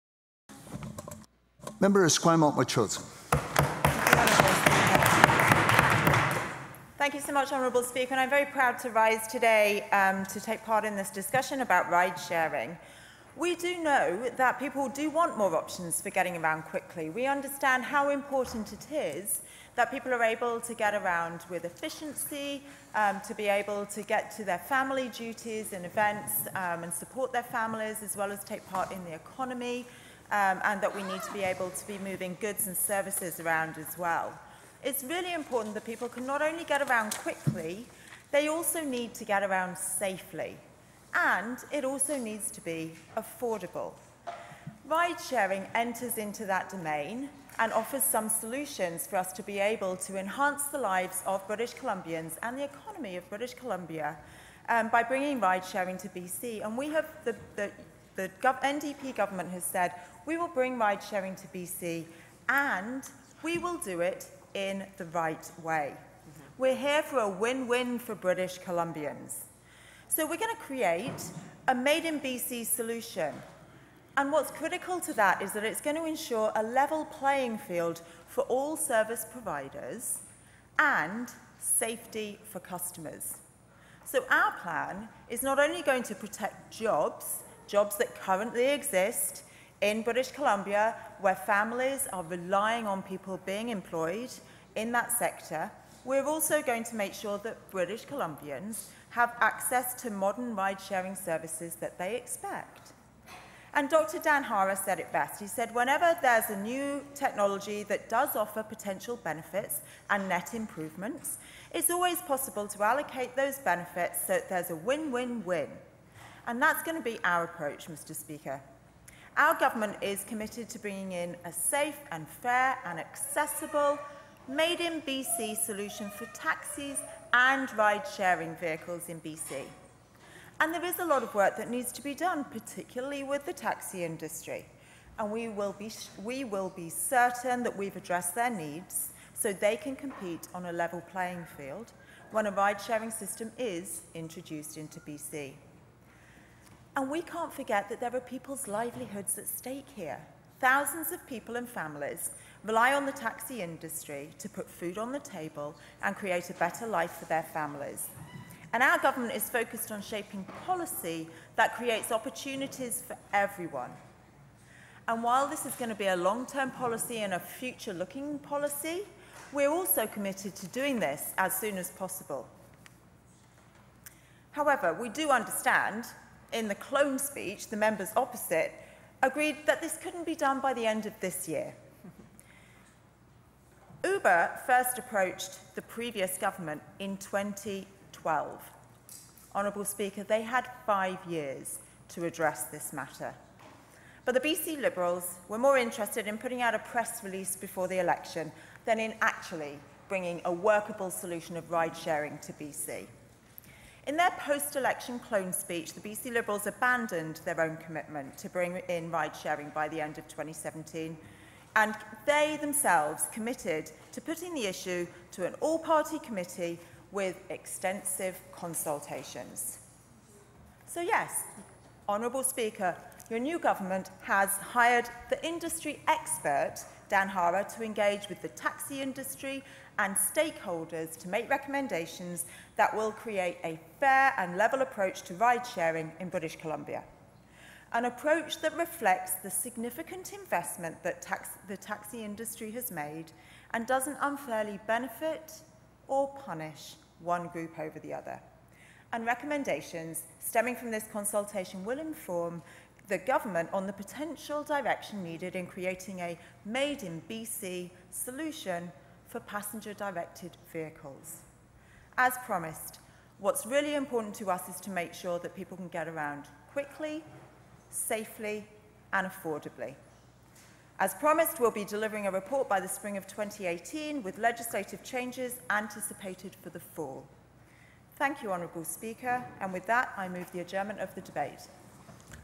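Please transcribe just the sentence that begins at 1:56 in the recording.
And that's going to be our approach, Mr Speaker.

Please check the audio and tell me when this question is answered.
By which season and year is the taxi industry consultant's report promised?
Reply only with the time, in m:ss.
4:32.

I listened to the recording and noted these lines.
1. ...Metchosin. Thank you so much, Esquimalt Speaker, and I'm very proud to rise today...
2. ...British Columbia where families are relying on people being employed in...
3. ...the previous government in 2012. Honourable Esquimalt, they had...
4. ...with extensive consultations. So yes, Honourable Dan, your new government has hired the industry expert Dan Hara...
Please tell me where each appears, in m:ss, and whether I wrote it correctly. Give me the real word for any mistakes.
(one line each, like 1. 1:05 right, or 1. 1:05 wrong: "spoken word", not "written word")
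1. 0:02 wrong: "Honourable", not "Esquimalt"
2. 1:30 right
3. 3:05 wrong: "Speaker", not "Esquimalt"
4. 3:37 wrong: "Speaker", not "Dan".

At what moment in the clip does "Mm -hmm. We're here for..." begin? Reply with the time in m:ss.
1:05.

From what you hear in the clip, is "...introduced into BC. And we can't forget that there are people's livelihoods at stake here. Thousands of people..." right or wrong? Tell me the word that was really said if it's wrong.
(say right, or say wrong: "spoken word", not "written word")
right.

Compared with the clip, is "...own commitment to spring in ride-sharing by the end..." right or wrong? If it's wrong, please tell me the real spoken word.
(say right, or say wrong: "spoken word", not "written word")
wrong: "bring", not "spring".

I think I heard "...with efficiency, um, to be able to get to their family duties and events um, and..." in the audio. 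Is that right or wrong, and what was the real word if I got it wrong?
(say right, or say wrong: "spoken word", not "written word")
right.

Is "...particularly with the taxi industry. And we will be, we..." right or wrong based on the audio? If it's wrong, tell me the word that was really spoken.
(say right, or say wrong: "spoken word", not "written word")
right.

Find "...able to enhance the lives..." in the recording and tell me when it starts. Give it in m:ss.
0:49.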